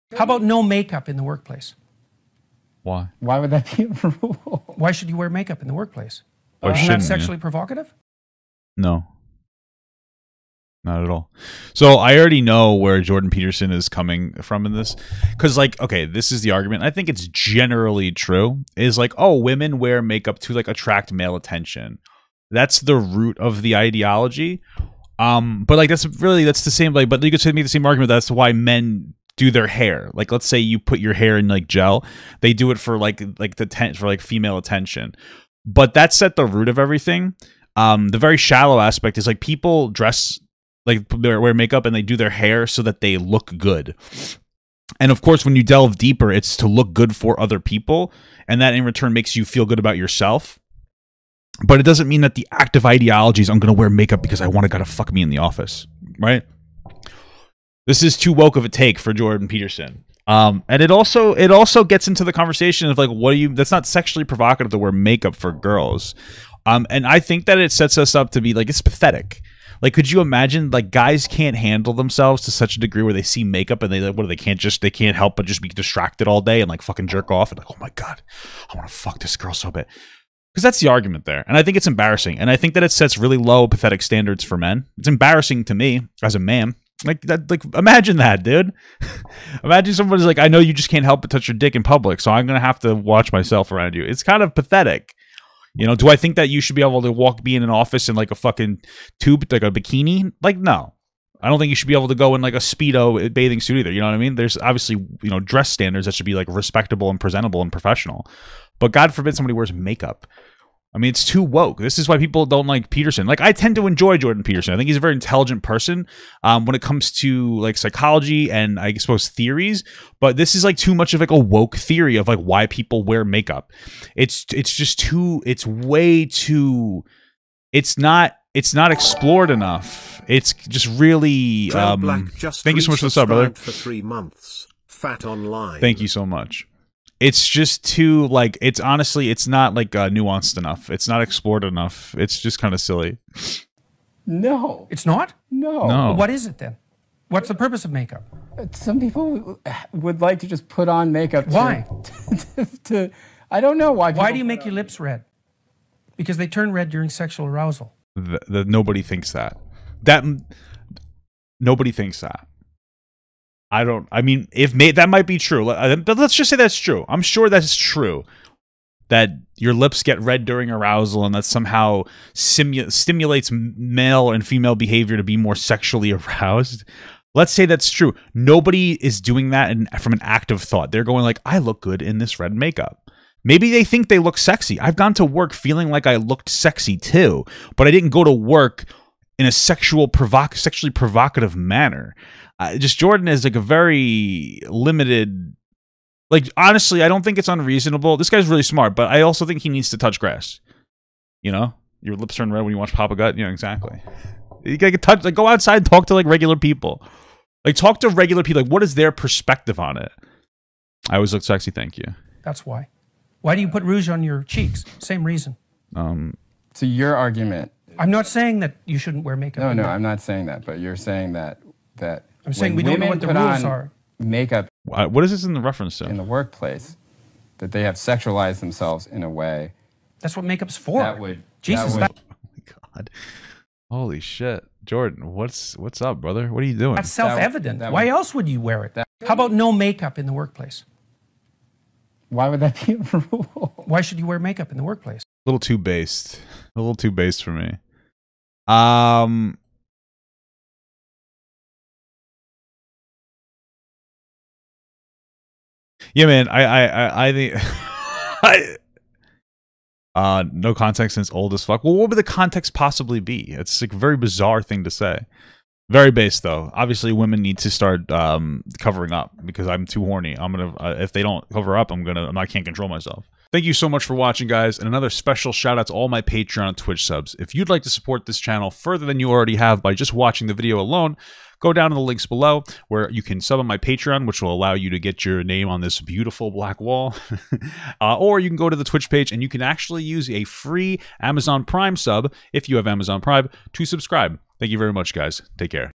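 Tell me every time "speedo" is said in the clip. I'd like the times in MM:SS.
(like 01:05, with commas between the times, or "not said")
01:42.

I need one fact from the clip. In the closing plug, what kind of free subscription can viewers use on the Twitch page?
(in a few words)
Amazon Prime sub.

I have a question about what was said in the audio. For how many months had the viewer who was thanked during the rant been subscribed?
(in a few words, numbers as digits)
3.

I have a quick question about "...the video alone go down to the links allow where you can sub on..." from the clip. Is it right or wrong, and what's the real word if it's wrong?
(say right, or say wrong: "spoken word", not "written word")
wrong: "below", not "allow".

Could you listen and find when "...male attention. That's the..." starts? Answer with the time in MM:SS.
00:21.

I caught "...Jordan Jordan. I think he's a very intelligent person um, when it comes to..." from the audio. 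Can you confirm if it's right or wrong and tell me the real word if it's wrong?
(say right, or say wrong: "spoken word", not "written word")
wrong: "Peterson", not "Jordan".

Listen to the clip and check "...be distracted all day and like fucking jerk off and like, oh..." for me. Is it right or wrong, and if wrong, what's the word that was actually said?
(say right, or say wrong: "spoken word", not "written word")
right.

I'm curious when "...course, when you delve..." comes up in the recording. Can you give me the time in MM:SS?
00:45.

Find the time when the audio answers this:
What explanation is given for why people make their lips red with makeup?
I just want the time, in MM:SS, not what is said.
02:37.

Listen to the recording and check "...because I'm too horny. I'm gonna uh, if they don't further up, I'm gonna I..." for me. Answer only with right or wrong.
wrong.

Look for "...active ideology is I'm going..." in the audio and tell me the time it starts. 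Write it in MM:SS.
00:52.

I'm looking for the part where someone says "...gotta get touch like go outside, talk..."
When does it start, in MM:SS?
03:24.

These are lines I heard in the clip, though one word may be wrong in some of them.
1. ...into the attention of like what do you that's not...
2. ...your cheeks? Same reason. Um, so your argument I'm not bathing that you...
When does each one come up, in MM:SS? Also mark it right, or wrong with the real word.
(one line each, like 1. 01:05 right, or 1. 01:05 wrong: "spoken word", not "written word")
1. 01:02 wrong: "conversation", not "attention"
2. 03:34 wrong: "saying", not "bathing".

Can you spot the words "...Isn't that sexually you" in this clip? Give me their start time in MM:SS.
00:06.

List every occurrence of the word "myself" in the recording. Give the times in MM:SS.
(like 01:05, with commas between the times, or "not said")
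01:33, 04:32.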